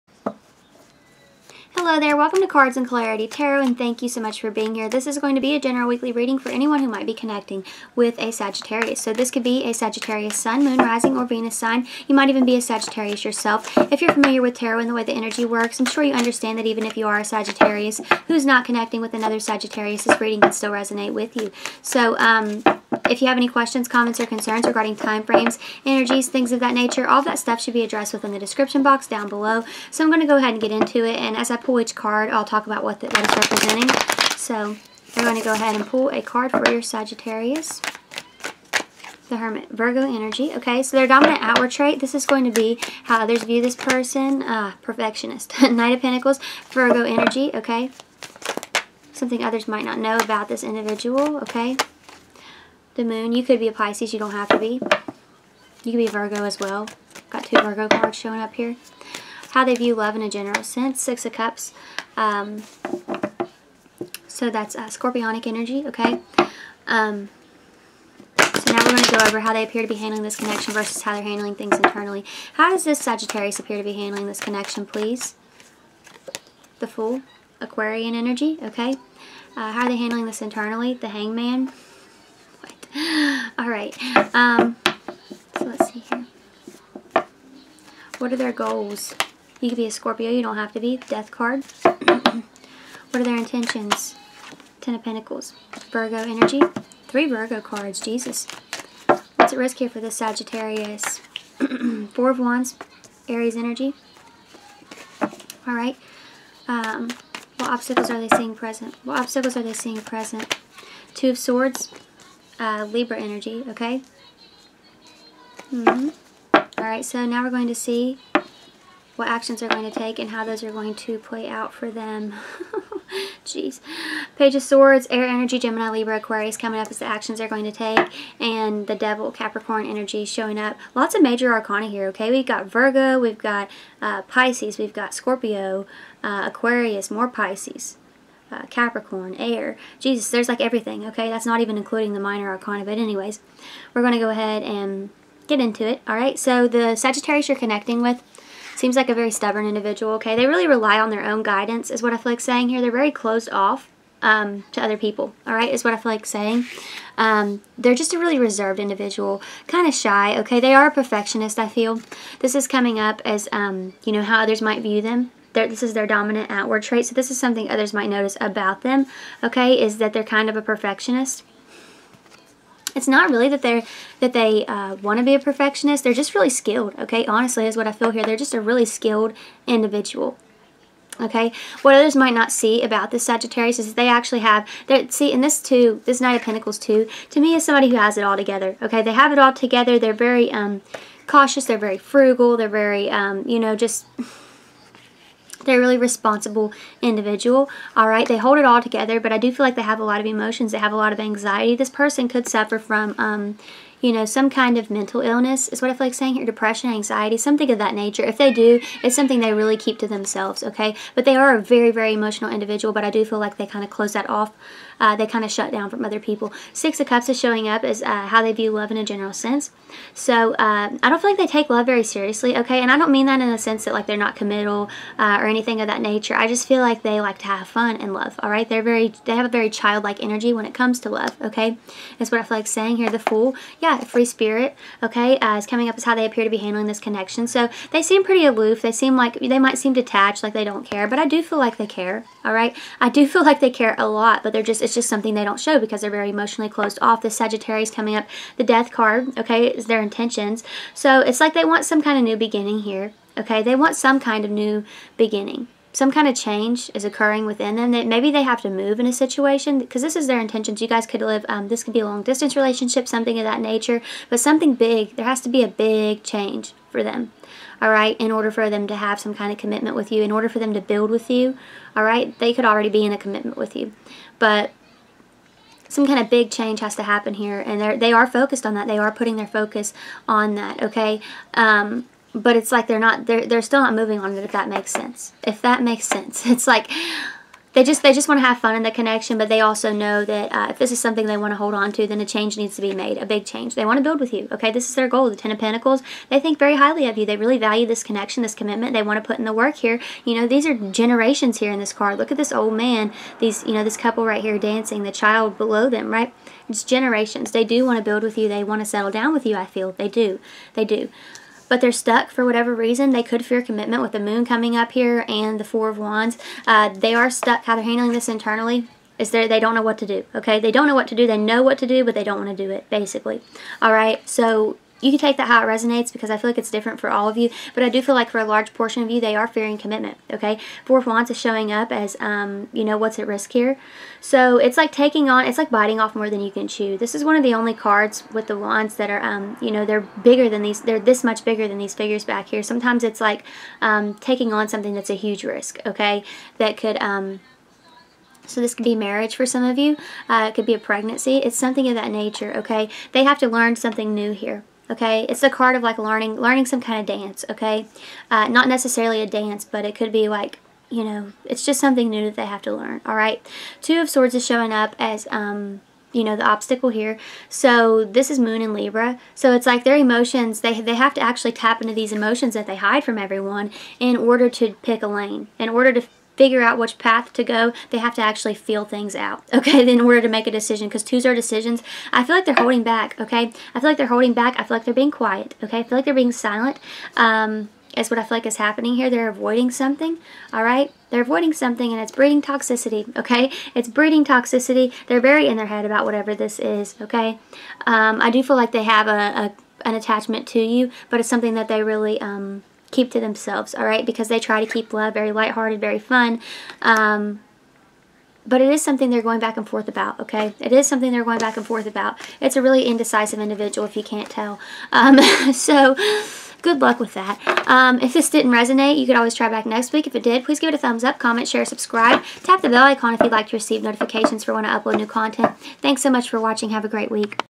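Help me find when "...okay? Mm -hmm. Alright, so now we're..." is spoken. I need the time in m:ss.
1:53.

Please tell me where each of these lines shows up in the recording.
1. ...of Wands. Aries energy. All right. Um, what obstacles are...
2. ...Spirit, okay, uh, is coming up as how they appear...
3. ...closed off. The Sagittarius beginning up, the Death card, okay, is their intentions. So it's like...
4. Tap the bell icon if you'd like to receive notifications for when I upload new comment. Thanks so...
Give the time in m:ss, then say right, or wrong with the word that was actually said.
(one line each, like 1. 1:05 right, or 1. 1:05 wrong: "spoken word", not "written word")
1. 1:42 right
2. 3:54 right
3. 4:06 wrong: "coming", not "beginning"
4. 7:02 wrong: "content", not "comment".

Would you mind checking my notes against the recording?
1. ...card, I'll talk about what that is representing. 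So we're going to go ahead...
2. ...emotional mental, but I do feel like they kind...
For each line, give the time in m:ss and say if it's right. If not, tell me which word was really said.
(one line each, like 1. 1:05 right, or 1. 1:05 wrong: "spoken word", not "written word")
1. 0:31 right
2. 3:32 wrong: "individual", not "mental".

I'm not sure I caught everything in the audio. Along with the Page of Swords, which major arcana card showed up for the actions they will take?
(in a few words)
The Devil.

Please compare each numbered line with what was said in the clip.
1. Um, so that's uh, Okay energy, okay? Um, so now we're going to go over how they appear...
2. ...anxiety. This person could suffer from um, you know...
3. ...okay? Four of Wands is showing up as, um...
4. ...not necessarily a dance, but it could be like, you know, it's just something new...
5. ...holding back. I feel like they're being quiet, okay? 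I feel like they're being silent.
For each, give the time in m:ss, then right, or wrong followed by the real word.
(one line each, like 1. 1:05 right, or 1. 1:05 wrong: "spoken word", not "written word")
1. 1:02 wrong: "Scorpionic", not "Okay"
2. 3:21 right
3. 5:30 right
4. 5:58 right
5. 6:24 right.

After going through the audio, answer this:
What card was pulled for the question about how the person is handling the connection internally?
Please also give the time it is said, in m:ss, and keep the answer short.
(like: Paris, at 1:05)
The Hangman, at 1:20.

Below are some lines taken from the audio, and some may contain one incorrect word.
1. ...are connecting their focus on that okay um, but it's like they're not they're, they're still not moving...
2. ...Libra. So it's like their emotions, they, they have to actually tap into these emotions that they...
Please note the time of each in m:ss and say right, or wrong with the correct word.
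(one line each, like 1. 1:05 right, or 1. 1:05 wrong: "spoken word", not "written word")
1. 4:38 wrong: "putting", not "connecting"
2. 6:08 right.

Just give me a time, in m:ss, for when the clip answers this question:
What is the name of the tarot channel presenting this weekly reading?
0:02.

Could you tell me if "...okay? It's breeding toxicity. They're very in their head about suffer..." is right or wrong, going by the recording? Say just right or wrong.
wrong.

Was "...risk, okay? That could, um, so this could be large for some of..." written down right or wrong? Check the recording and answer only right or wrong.
wrong.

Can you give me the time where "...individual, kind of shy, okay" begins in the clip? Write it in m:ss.
2:38.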